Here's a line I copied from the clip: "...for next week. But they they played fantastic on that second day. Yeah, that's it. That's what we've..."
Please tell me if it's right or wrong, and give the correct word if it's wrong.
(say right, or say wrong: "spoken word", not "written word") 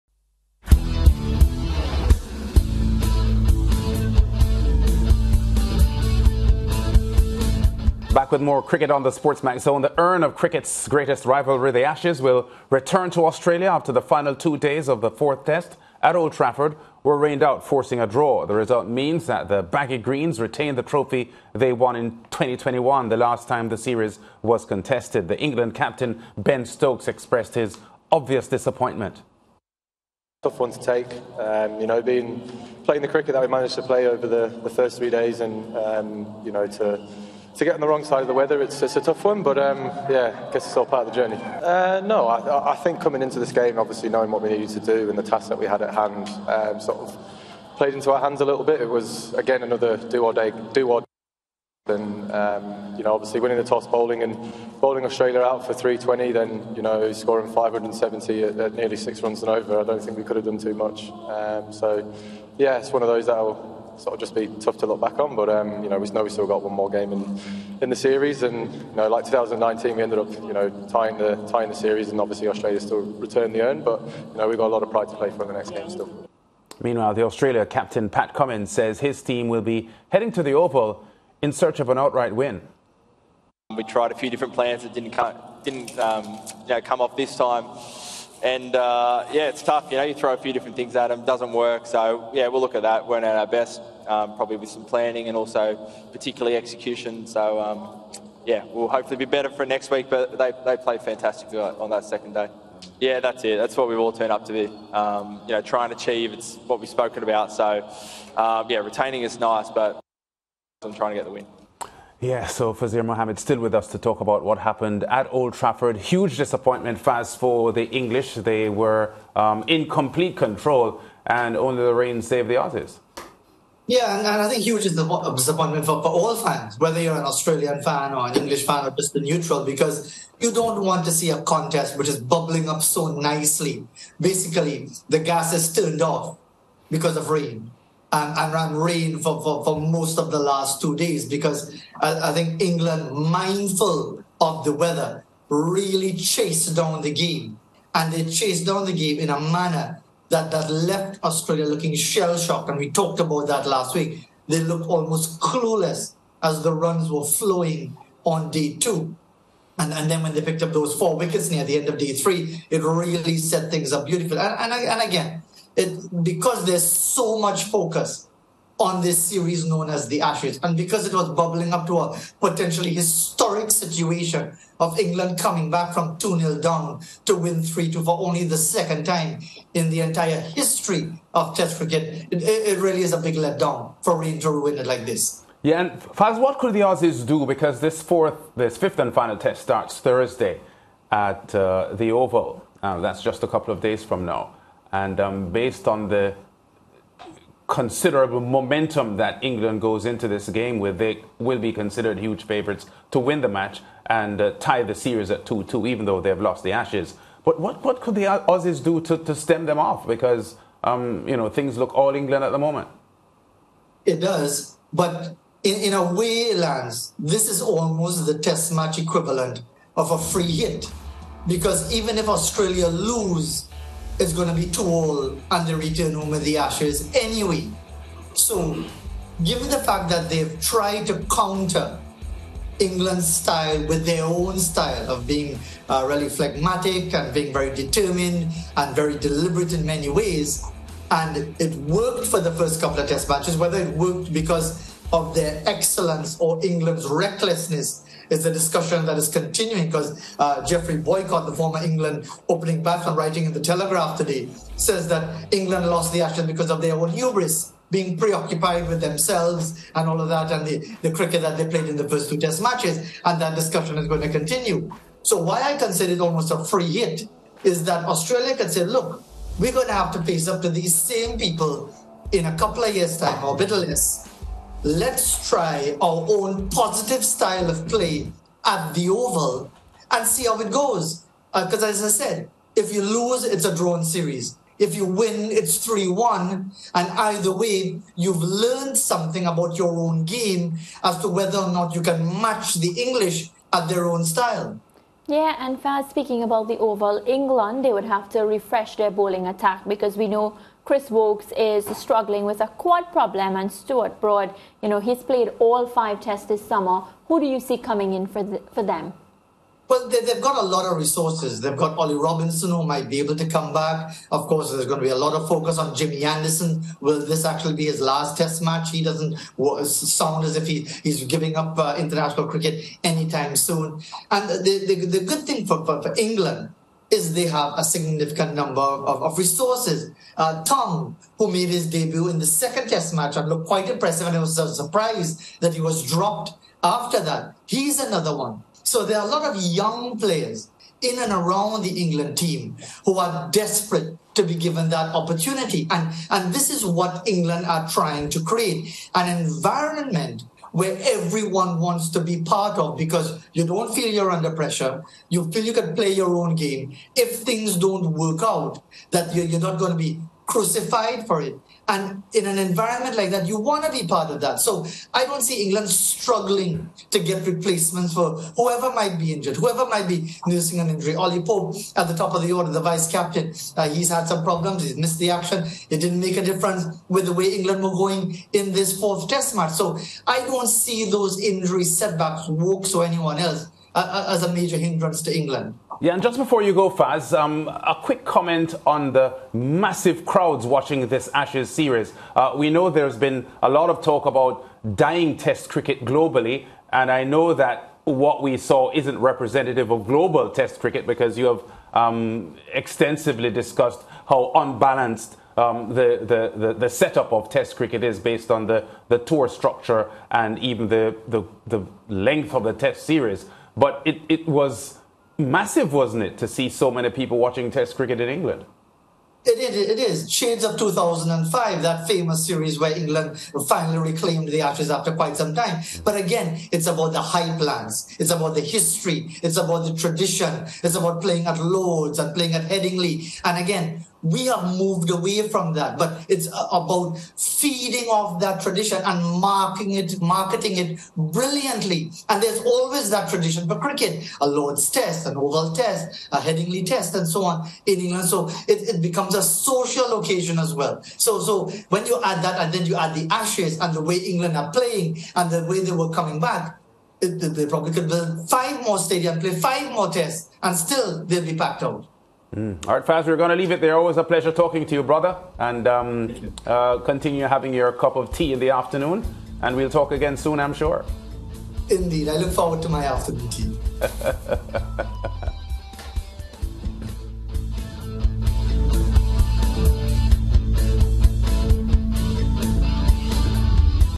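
right.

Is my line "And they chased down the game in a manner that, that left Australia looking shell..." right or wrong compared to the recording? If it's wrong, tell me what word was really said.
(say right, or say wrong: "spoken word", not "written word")
right.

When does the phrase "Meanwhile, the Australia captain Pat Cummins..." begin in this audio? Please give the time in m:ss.
1:16.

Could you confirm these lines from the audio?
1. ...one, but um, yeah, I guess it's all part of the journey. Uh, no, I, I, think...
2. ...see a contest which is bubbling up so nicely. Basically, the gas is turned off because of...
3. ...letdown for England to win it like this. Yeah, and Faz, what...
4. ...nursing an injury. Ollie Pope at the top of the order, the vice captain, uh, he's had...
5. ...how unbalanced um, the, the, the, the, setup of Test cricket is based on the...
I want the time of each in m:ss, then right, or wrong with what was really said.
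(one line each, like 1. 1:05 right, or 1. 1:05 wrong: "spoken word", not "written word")
1. 0:39 right
2. 2:11 right
3. 3:03 right
4. 6:10 right
5. 6:44 right.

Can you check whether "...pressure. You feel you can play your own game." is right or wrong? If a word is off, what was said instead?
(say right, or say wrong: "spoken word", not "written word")
right.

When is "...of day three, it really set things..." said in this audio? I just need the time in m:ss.
2:41.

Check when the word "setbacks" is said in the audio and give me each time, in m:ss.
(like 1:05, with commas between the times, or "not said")
6:21.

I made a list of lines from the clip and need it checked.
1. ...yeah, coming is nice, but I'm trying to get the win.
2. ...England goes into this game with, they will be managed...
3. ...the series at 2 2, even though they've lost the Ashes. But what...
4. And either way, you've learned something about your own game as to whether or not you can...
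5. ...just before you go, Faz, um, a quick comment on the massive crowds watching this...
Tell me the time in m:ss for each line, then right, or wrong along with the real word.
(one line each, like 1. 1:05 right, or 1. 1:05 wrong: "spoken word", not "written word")
1. 1:48 wrong: "retaining", not "coming"
2. 3:19 wrong: "considered", not "managed"
3. 3:24 right
4. 4:46 right
5. 6:26 right.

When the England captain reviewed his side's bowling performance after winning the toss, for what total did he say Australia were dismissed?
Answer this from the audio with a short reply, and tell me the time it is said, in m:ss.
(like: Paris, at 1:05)
320, at 0:55.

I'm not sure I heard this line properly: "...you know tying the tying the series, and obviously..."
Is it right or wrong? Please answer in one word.
right.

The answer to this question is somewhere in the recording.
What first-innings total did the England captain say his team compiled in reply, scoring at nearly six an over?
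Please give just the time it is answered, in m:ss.
0:57.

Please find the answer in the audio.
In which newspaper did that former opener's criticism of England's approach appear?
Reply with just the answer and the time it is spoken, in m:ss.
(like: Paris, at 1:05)
The Telegraph, at 4:13.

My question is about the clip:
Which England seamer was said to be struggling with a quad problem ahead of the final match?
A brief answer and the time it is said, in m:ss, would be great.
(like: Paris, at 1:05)
Chris Woakes, at 5:00.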